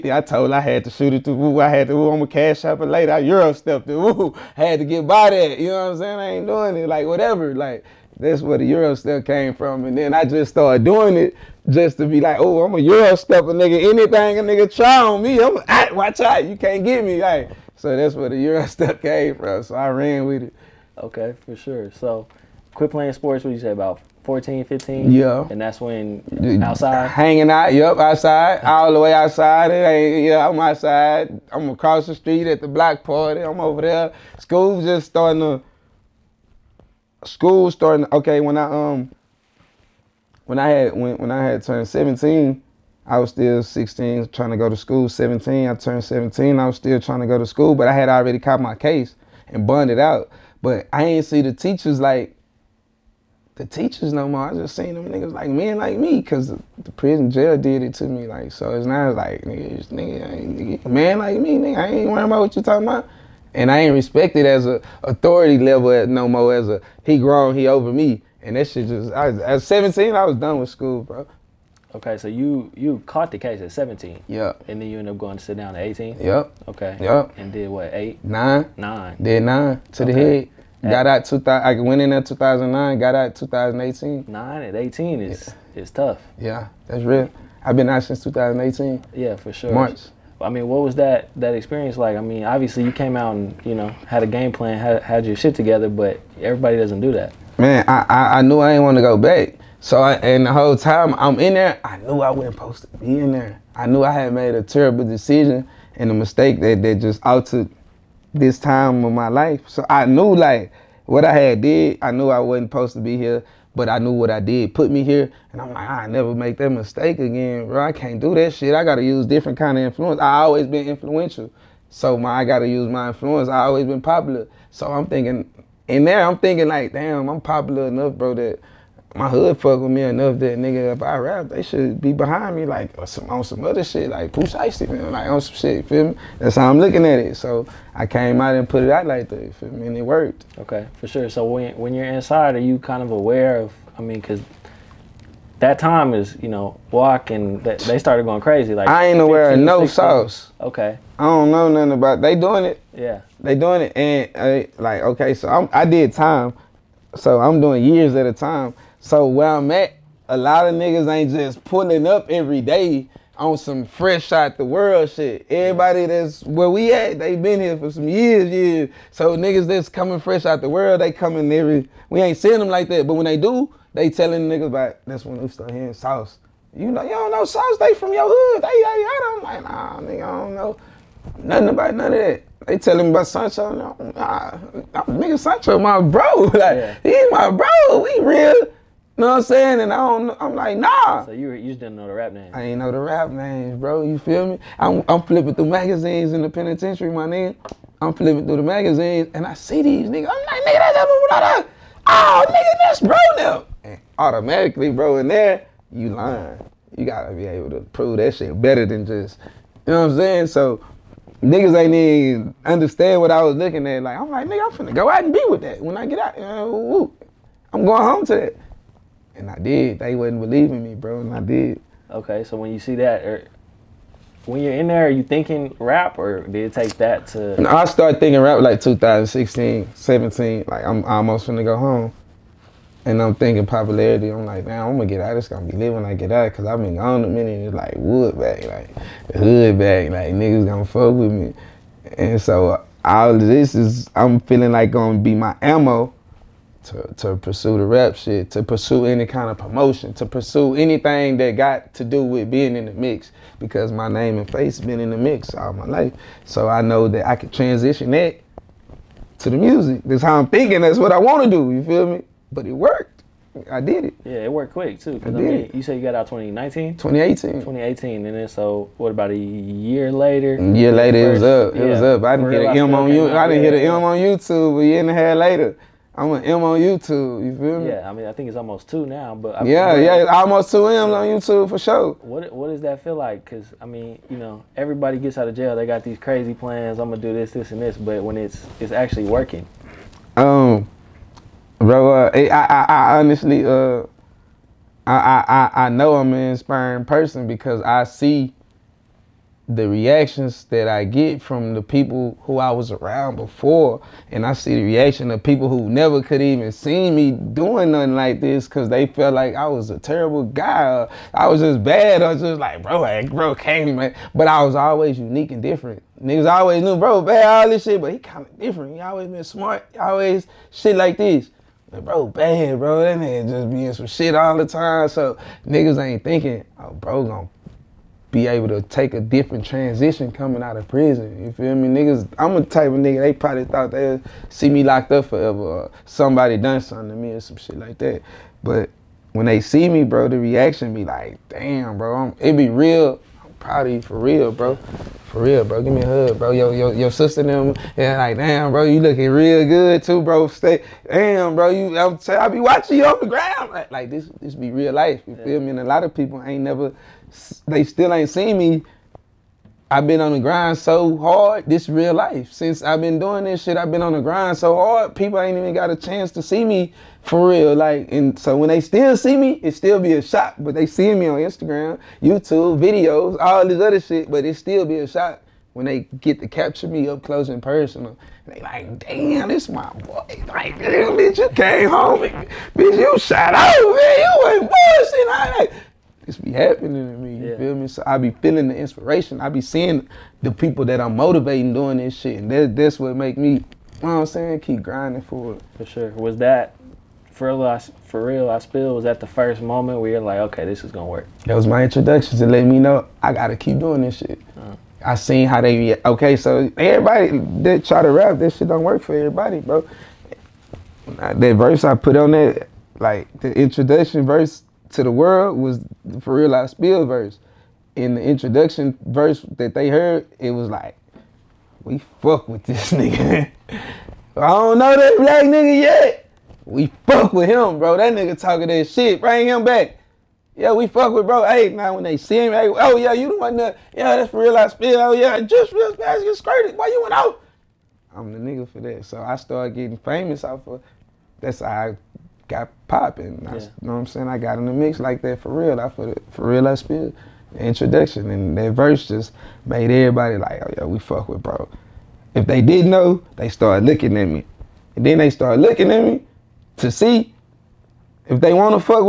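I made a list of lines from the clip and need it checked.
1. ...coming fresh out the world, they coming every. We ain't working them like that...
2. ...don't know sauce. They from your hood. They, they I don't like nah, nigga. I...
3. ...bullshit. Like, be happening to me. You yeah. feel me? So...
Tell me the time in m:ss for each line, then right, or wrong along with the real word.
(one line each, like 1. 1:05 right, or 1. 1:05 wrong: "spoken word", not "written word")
1. 2:49 wrong: "seeing", not "working"
2. 2:57 right
3. 6:24 right.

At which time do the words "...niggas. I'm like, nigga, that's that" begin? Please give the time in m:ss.
3:20.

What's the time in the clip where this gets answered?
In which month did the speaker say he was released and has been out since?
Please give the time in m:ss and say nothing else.
1:29.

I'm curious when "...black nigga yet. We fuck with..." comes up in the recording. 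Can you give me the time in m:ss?
7:05.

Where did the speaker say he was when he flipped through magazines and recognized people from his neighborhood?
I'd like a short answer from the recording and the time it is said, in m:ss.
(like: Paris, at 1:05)
penitentiary, at 3:16.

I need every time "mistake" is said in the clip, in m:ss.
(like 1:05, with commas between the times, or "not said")
1:46, 1:56.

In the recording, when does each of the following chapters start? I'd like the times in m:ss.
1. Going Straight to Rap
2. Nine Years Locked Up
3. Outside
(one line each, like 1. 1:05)
1. 6:30
2. 1:12
3. 0:22.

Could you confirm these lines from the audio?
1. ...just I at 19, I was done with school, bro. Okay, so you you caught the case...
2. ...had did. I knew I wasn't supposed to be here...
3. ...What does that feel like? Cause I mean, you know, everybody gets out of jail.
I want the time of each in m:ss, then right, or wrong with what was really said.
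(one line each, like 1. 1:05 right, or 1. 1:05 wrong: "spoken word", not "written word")
1. 1:08 wrong: "17", not "19"
2. 1:51 right
3. 4:42 right.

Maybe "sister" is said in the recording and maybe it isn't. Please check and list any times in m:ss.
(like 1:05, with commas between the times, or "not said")
5:47.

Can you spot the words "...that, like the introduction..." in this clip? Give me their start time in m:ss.
6:52.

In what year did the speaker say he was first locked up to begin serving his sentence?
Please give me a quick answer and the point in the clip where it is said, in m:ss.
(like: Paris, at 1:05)
2009, at 1:22.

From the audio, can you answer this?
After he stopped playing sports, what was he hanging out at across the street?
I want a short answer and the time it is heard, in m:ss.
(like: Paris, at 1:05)
block party, at 0:32.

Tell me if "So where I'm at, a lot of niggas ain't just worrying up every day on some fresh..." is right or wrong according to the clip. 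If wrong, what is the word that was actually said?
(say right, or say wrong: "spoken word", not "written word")
wrong: "pulling", not "worrying".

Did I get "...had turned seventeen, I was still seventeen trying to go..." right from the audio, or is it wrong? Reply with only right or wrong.
wrong.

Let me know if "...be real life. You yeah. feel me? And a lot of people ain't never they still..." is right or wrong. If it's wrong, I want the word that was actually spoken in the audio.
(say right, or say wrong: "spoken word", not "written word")
right.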